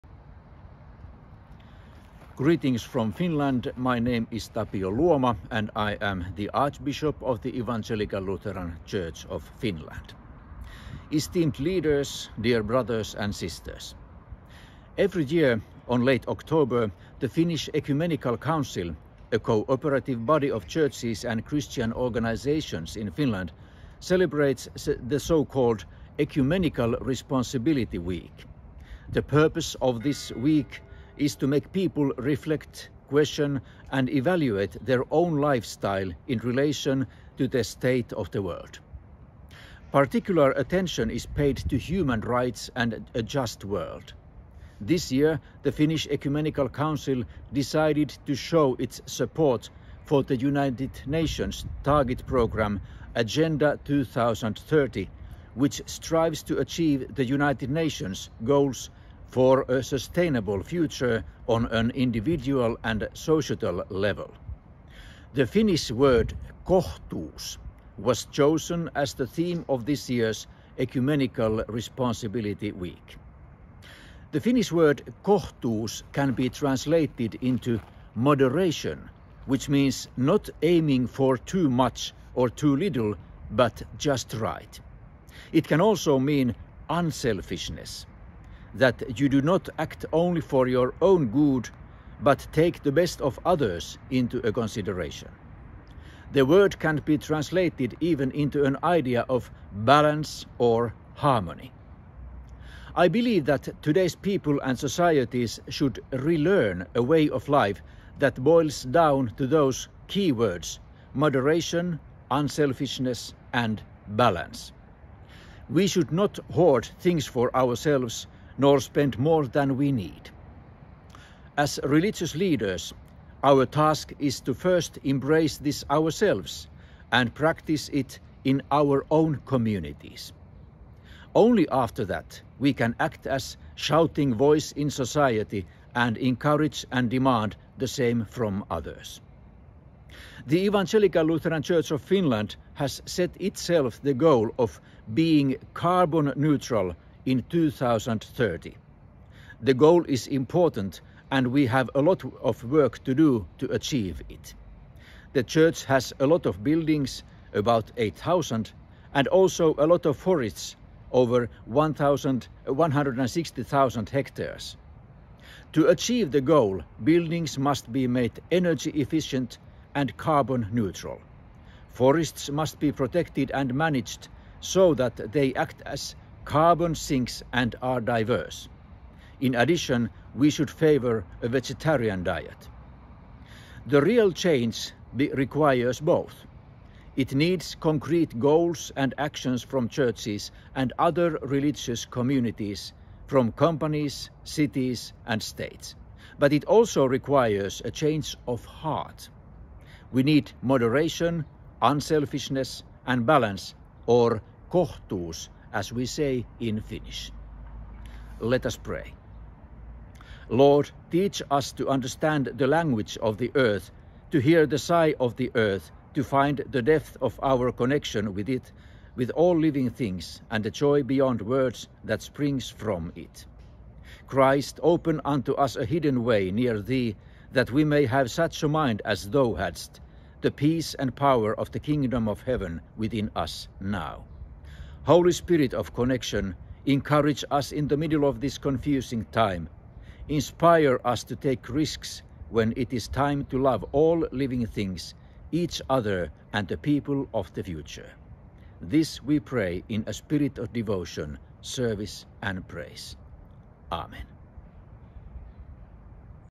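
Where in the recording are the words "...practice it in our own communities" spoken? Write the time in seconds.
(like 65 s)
127 s.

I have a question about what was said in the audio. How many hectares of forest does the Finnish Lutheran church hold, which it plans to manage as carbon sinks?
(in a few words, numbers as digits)
Over 160,000 hectares.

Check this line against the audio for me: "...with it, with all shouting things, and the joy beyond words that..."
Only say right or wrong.
wrong.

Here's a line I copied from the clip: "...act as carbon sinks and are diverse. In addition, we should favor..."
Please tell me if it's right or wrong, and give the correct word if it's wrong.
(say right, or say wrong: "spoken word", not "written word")
right.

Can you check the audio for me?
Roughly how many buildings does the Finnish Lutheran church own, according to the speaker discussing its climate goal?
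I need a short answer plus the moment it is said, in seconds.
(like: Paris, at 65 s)
8,000, at 157 s.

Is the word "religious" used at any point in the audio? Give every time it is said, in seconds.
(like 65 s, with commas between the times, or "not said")
121 s, 191 s.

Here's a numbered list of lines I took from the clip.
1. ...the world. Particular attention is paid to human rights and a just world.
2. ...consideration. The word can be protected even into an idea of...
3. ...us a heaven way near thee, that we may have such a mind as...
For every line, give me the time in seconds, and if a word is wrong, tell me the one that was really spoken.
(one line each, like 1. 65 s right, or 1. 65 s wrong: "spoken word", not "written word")
1. 38 s right
2. 94 s wrong: "translated", not "protected"
3. 225 s wrong: "hidden", not "heaven".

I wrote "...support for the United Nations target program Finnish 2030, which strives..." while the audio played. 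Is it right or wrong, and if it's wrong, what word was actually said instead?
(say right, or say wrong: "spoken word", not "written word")
wrong: "Agenda", not "Finnish".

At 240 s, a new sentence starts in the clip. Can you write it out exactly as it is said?
Inspire us to take risks when it is time to love all living things, each other, and the people of the future.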